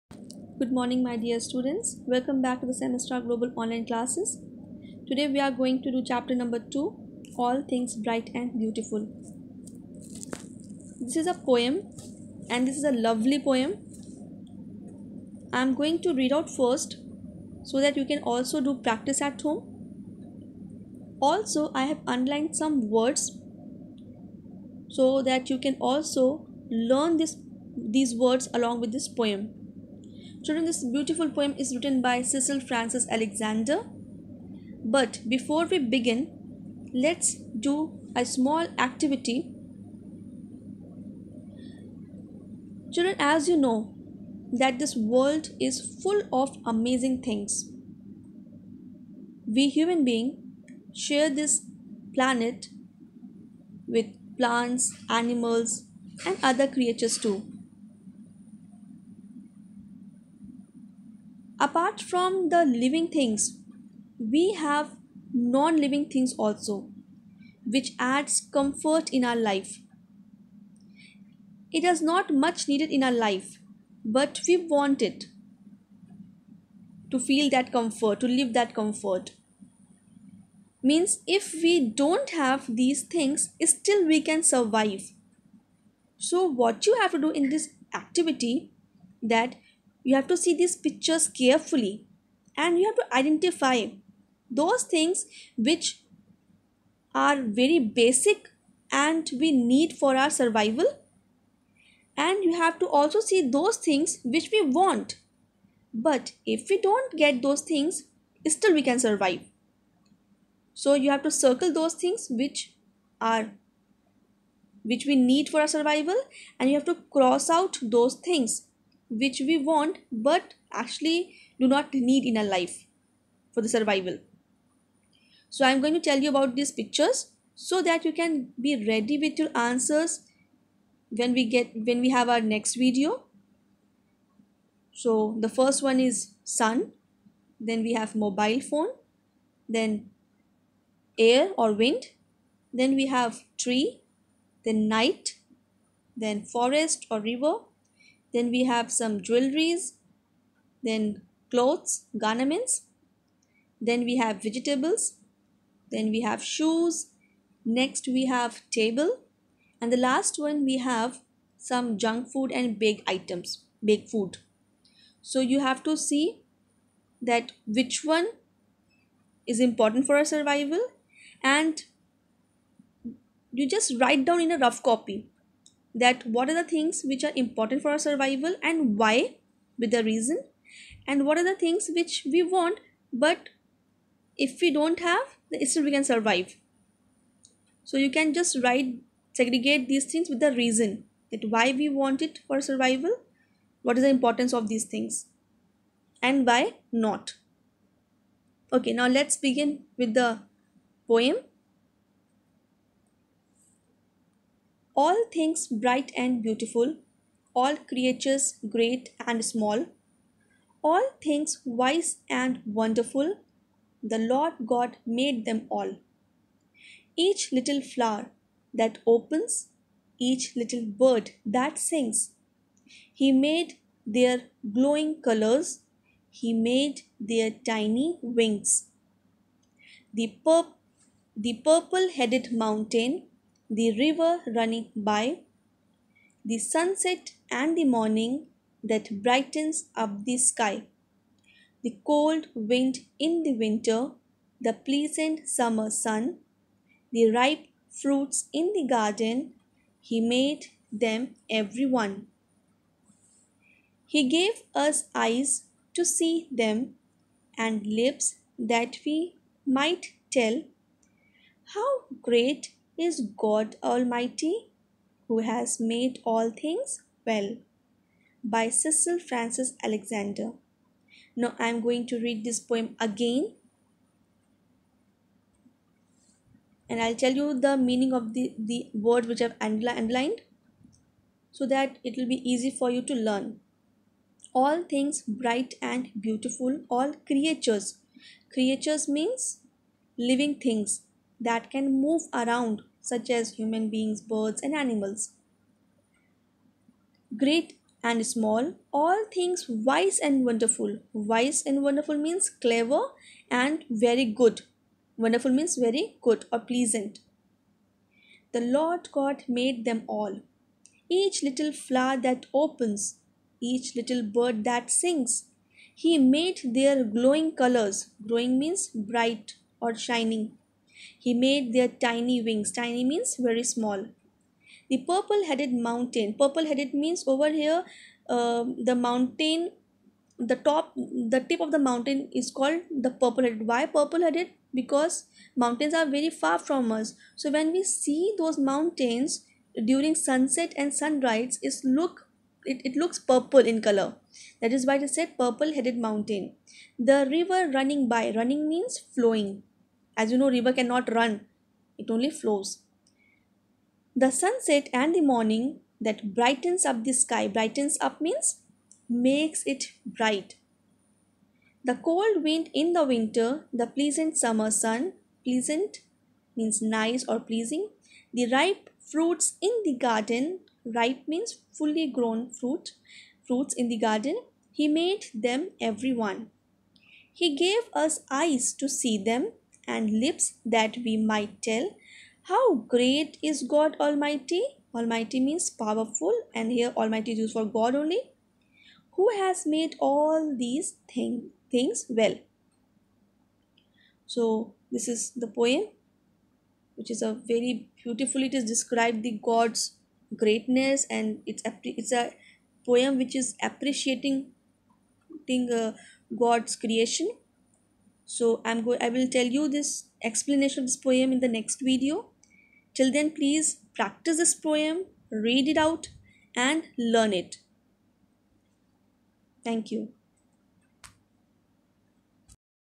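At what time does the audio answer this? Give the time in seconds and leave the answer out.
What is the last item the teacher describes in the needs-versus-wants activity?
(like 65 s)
161 s.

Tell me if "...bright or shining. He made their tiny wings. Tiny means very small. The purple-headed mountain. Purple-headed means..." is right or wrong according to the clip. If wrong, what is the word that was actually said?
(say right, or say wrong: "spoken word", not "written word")
right.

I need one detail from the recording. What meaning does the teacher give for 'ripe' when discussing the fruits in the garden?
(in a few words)
fully grown.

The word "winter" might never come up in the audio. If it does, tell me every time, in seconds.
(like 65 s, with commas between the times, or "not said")
243 s, 363 s.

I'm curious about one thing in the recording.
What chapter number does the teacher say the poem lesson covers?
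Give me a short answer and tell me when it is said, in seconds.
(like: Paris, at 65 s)
2, at 6 s.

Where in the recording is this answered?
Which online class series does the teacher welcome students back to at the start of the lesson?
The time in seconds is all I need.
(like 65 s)
2 s.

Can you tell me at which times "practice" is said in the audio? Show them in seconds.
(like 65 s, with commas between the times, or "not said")
18 s, 413 s.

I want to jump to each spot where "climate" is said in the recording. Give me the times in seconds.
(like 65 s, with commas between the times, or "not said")
not said.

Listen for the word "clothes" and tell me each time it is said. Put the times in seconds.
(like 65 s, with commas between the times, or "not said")
151 s.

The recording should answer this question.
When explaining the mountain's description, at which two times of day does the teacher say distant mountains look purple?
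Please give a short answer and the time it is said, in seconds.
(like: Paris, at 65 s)
sunset and sunrise, at 340 s.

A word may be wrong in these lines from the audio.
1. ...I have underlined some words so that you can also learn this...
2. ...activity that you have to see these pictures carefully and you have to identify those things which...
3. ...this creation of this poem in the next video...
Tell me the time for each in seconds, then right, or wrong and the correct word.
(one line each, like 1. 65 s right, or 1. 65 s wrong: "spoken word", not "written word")
1. 21 s right
2. 88 s right
3. 409 s wrong: "explanation", not "creation".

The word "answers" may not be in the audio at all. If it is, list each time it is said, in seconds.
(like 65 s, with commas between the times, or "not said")
129 s.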